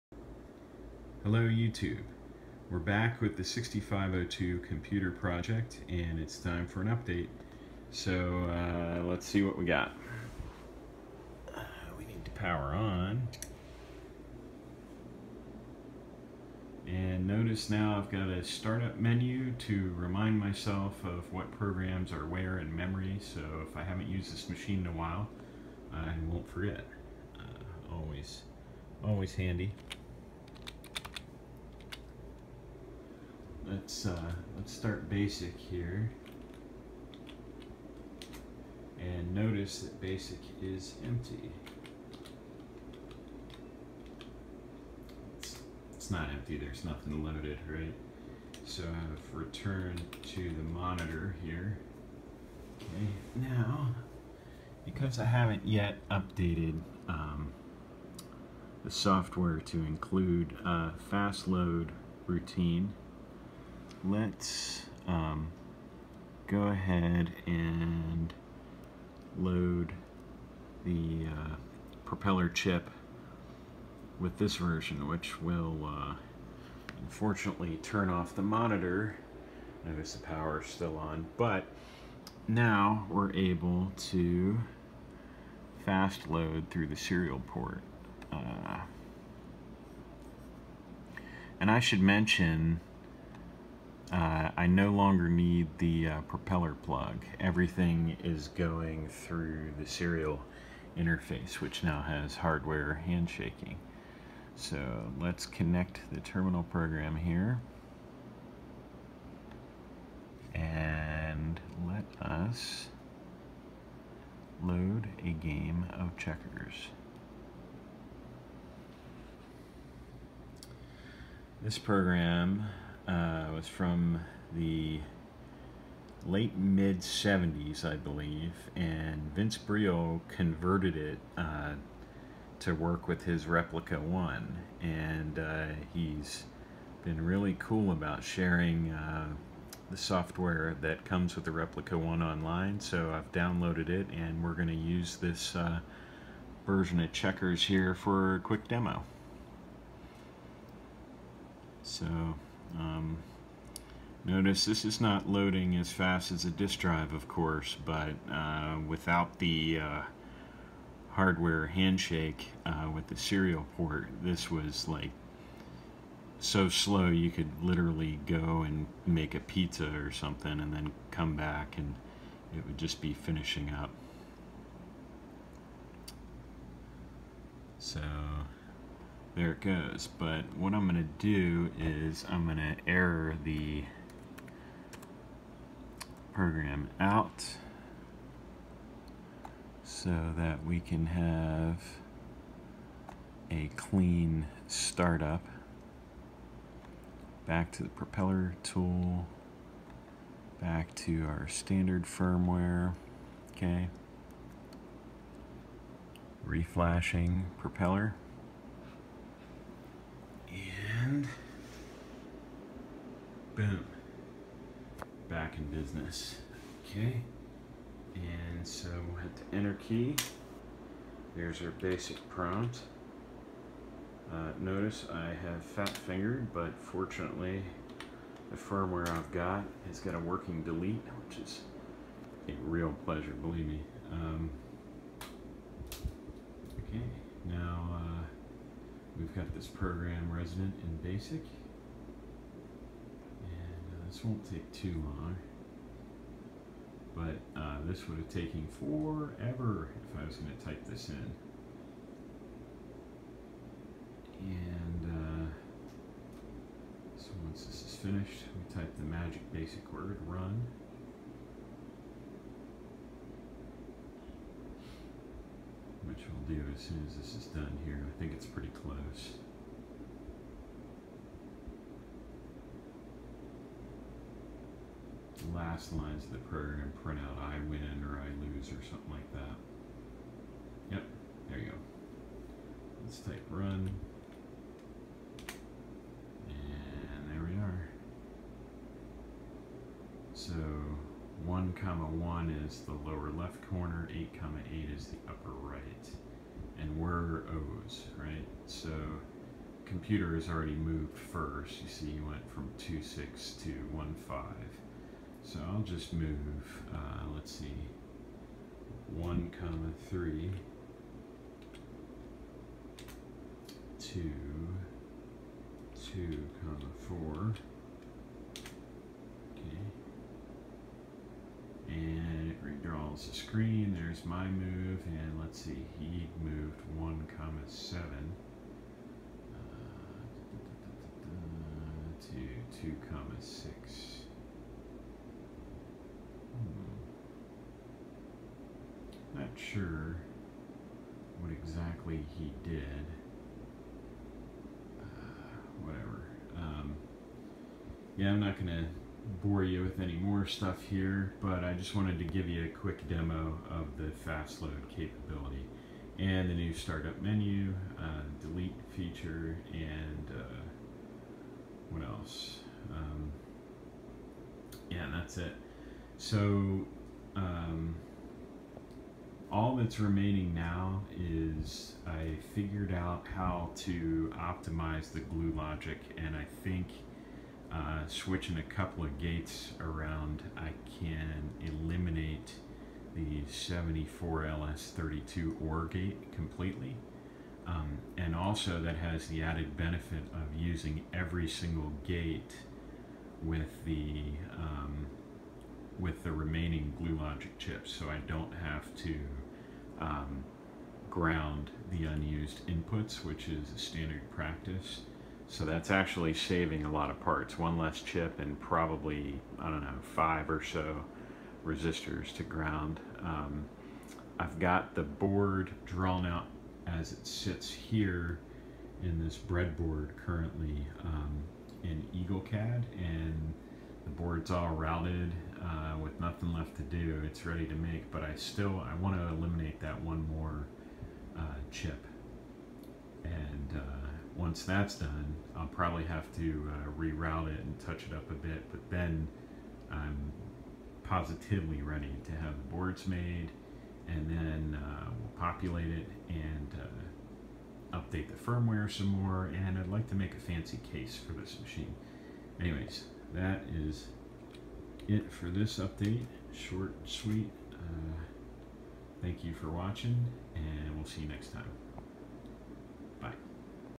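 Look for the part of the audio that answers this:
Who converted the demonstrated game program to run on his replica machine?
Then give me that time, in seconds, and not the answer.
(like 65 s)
129 s.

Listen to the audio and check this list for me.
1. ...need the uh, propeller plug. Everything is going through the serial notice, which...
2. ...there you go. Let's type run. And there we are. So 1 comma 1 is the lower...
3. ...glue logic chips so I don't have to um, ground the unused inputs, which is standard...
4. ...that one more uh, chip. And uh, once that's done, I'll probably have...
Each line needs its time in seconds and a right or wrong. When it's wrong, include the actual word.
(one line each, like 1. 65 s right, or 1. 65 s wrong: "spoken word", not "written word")
1. 95 s wrong: "interface", not "notice"
2. 281 s right
3. 396 s right
4. 429 s right.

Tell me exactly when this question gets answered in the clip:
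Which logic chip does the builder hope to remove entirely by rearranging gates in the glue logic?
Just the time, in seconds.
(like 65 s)
383 s.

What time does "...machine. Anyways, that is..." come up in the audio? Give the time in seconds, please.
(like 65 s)
451 s.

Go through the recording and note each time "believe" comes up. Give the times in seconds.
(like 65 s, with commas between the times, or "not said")
127 s, 233 s.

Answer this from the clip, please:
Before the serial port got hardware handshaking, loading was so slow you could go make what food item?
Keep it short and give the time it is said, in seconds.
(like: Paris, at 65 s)
A pizza, at 169 s.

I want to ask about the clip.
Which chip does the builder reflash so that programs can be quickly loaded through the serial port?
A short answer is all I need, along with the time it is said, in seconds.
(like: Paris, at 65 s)
Propeller chip, at 72 s.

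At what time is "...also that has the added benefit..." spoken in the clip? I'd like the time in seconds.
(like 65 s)
388 s.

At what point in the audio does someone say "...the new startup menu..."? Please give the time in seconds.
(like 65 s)
356 s.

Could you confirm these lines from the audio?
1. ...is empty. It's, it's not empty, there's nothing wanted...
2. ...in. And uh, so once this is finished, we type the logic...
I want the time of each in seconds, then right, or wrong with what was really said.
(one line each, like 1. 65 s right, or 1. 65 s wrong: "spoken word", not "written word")
1. 40 s wrong: "loaded", not "wanted"
2. 251 s wrong: "magic", not "logic".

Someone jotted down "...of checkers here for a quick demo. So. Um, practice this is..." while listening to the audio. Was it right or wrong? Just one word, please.
wrong.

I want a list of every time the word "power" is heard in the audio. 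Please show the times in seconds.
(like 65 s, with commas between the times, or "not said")
12 s, 80 s.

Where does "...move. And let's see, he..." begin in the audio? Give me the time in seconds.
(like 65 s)
324 s.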